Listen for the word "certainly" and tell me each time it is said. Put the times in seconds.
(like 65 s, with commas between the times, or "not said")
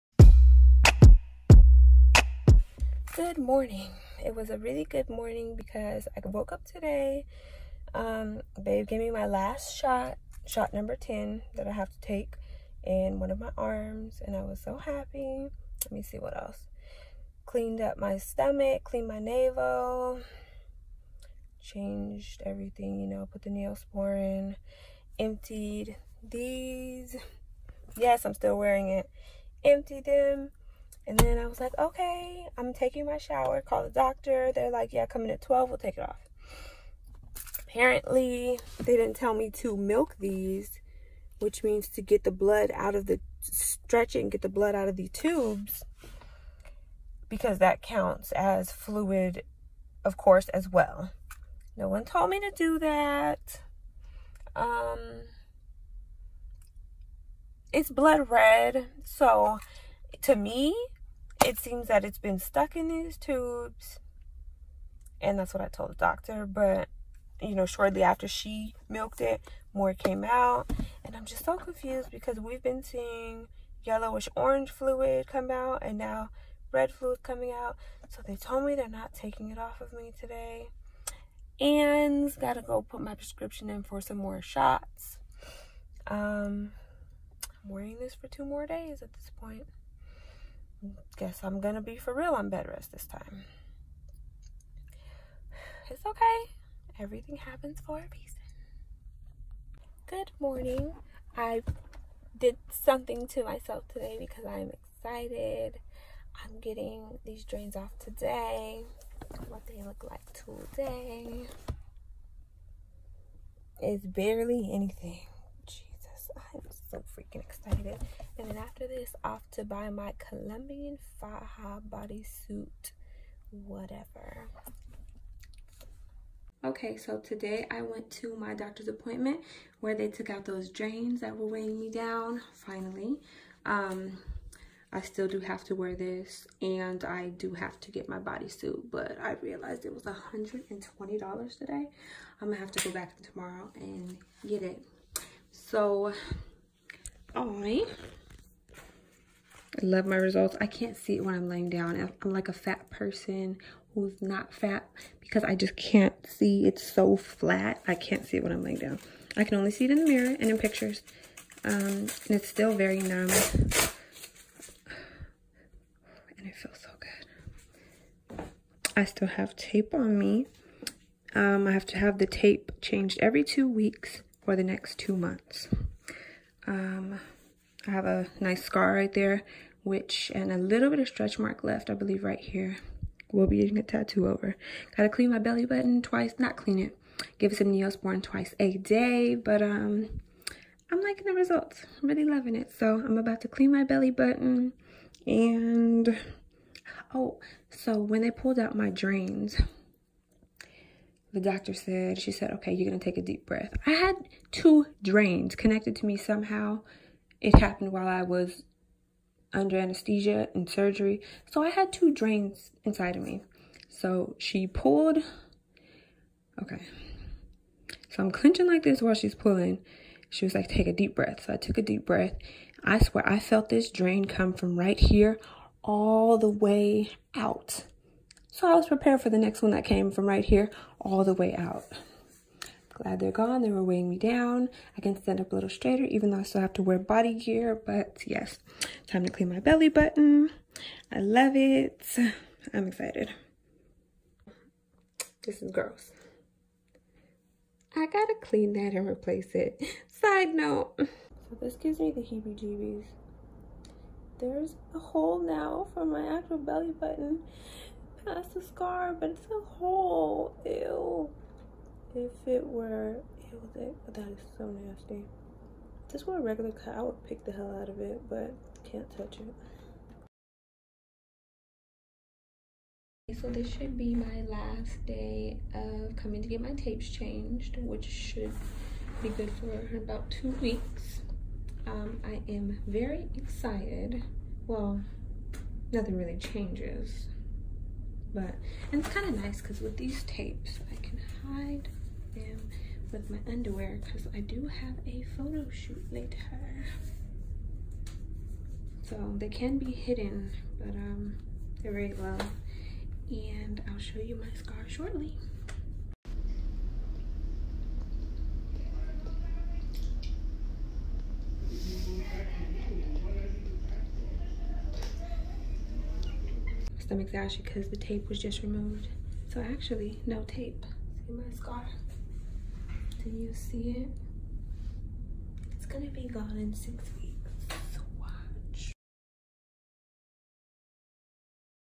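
not said.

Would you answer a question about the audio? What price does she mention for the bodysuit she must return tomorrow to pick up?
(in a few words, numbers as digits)
$120.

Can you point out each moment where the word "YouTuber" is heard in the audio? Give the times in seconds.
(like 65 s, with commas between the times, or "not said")
not said.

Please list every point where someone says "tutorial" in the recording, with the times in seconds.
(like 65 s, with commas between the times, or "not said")
not said.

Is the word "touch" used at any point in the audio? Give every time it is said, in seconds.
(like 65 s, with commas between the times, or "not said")
269 s.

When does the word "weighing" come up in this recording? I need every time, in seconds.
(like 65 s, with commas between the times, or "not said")
131 s, 233 s.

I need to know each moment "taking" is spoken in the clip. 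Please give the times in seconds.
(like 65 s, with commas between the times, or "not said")
32 s, 79 s.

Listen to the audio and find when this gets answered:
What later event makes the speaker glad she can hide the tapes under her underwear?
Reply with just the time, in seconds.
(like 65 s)
295 s.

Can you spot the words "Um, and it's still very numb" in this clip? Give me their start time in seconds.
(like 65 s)
161 s.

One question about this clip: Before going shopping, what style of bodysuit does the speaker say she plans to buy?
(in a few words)
Colombian Faja.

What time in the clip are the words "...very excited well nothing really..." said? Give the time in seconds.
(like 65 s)
282 s.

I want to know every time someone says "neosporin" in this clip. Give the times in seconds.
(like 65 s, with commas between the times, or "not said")
23 s, 187 s.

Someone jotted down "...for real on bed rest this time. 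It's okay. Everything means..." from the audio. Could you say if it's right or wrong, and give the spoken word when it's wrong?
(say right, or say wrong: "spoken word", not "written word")
wrong: "happens", not "means".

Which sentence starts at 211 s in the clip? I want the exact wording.
So I had two drains inside of me.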